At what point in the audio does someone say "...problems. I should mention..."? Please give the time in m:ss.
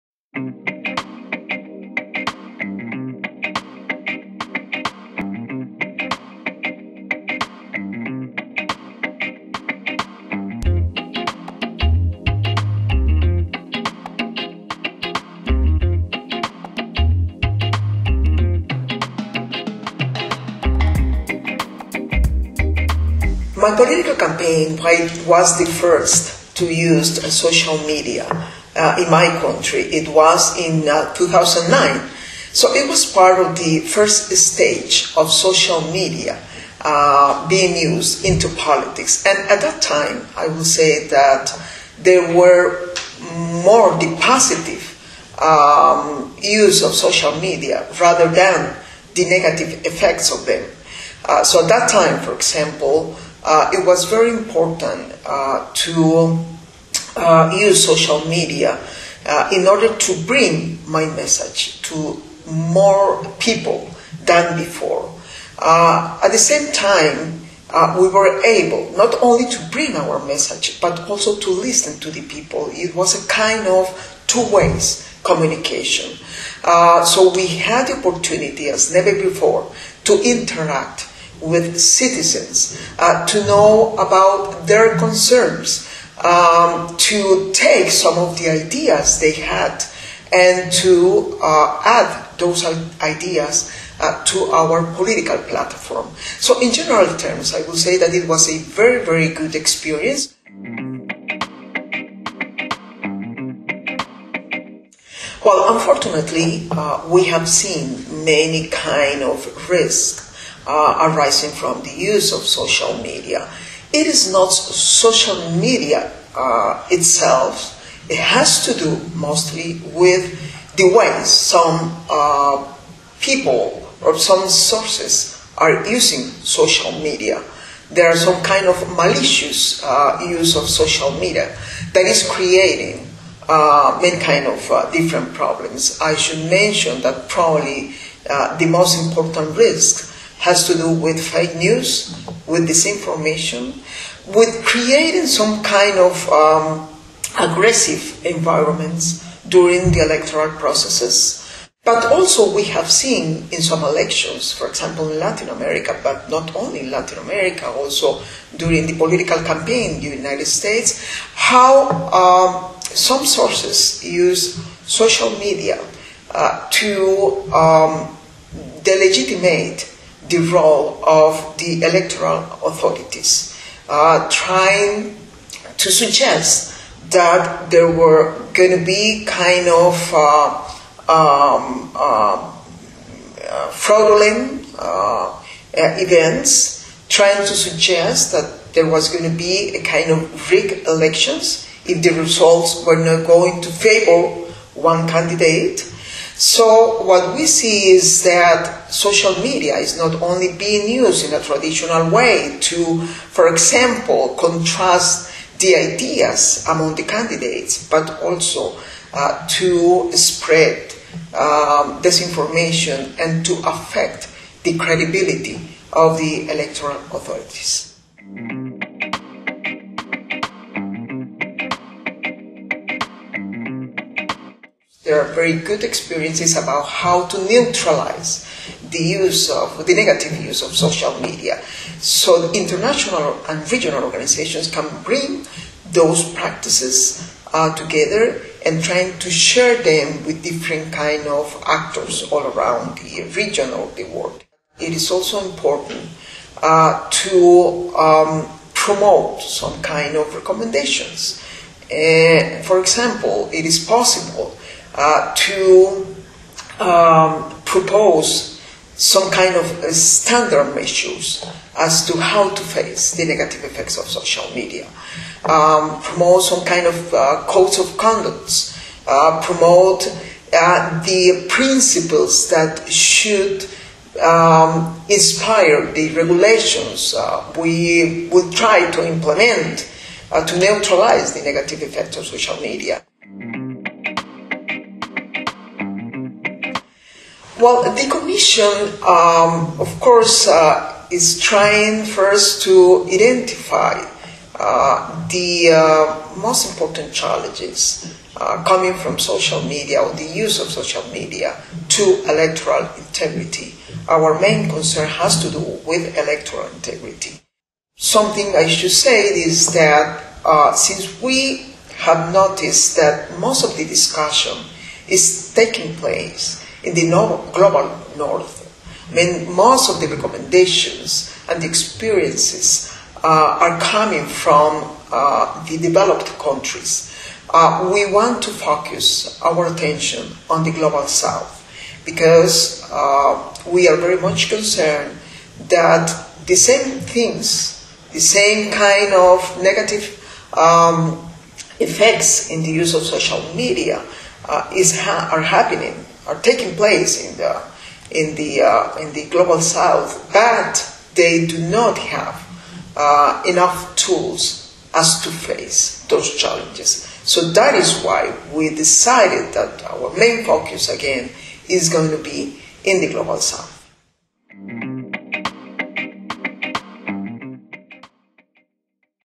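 2:15.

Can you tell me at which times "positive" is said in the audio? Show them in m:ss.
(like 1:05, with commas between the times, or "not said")
0:44.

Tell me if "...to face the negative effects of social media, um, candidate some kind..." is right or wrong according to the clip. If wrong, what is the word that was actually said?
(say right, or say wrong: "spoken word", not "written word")
wrong: "promote", not "candidate".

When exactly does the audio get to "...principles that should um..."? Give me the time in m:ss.
4:31.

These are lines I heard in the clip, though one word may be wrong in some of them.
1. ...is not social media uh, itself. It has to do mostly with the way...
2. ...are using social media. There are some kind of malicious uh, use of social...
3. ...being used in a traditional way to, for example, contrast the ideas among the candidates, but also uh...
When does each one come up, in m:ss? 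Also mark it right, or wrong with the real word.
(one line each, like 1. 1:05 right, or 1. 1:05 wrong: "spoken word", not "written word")
1. 1:54 right
2. 2:05 right
3. 3:20 right.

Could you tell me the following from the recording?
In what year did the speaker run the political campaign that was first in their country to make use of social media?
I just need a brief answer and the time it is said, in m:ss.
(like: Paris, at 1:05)
2009, at 0:31.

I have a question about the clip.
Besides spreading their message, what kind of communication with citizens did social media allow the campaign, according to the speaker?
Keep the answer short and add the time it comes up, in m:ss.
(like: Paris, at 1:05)
Two ways communication, at 1:14.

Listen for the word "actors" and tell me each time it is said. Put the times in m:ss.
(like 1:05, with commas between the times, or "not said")
4:01.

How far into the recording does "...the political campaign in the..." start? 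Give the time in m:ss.
2:38.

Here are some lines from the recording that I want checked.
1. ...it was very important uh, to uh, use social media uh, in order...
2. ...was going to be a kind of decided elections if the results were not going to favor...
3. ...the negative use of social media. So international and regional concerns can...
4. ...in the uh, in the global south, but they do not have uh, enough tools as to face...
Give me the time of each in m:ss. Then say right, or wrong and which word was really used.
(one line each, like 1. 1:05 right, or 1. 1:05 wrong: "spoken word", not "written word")
1. 0:53 right
2. 3:08 wrong: "rigged", not "decided"
3. 3:49 wrong: "organizations", not "concerns"
4. 5:48 right.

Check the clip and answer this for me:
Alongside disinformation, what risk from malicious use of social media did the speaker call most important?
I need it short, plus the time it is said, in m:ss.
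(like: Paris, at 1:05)
Fake news, at 2:21.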